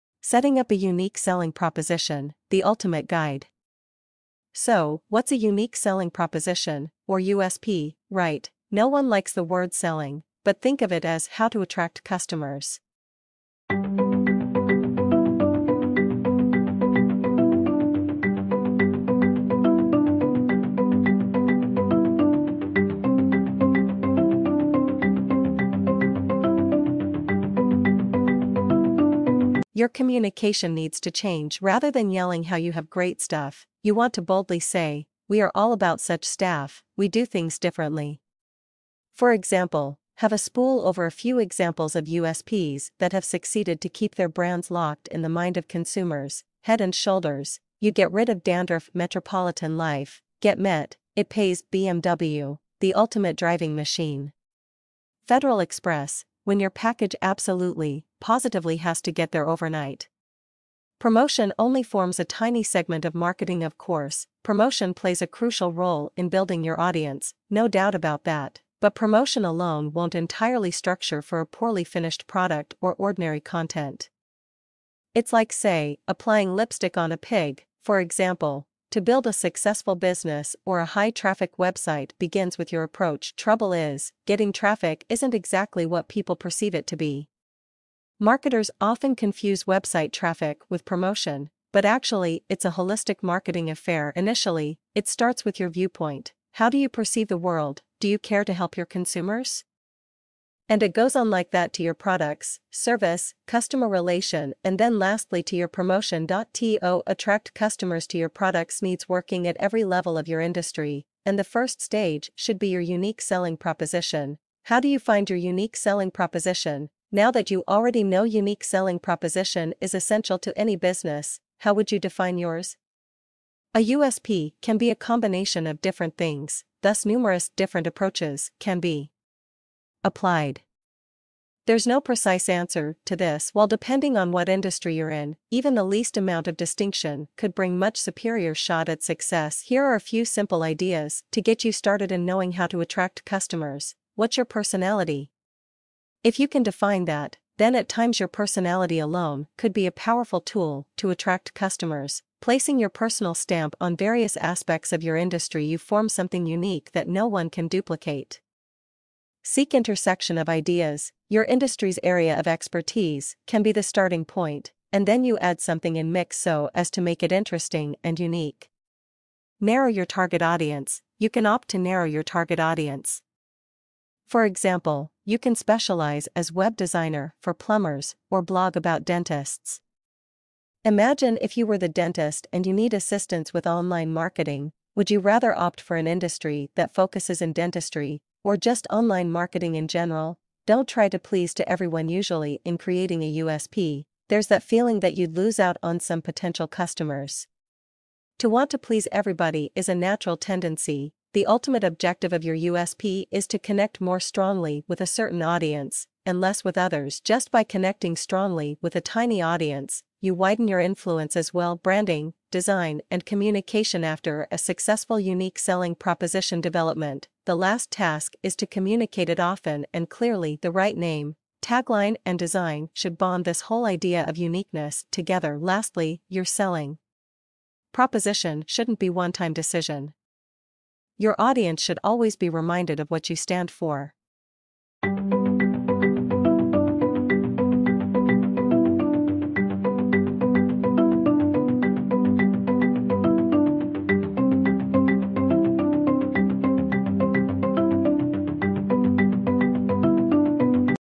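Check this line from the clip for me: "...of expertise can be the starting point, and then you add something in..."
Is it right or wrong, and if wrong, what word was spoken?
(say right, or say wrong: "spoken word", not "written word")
right.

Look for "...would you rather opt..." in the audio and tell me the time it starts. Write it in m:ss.
3:04.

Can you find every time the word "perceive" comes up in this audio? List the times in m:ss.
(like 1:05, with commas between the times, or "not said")
1:26, 1:36.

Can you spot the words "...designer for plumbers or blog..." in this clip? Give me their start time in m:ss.
2:56.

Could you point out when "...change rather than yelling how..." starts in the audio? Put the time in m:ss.
0:31.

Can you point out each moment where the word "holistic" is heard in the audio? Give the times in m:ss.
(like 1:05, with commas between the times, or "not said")
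1:32.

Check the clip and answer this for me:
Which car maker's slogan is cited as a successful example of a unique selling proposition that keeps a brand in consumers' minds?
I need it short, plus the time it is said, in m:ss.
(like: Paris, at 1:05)
BMW, at 0:51.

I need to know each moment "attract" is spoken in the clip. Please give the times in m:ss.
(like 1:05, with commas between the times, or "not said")
0:11, 1:47, 2:22, 2:31.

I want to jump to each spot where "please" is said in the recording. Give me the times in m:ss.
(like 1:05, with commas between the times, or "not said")
3:11, 3:18.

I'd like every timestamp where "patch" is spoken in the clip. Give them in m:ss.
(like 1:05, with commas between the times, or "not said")
not said.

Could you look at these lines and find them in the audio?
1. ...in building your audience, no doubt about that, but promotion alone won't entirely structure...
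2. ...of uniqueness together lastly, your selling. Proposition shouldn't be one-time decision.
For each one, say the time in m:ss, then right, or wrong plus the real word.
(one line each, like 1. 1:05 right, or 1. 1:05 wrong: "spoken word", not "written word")
1. 1:06 right
2. 3:44 right.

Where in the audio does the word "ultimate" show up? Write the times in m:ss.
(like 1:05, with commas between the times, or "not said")
0:02, 0:52, 3:21.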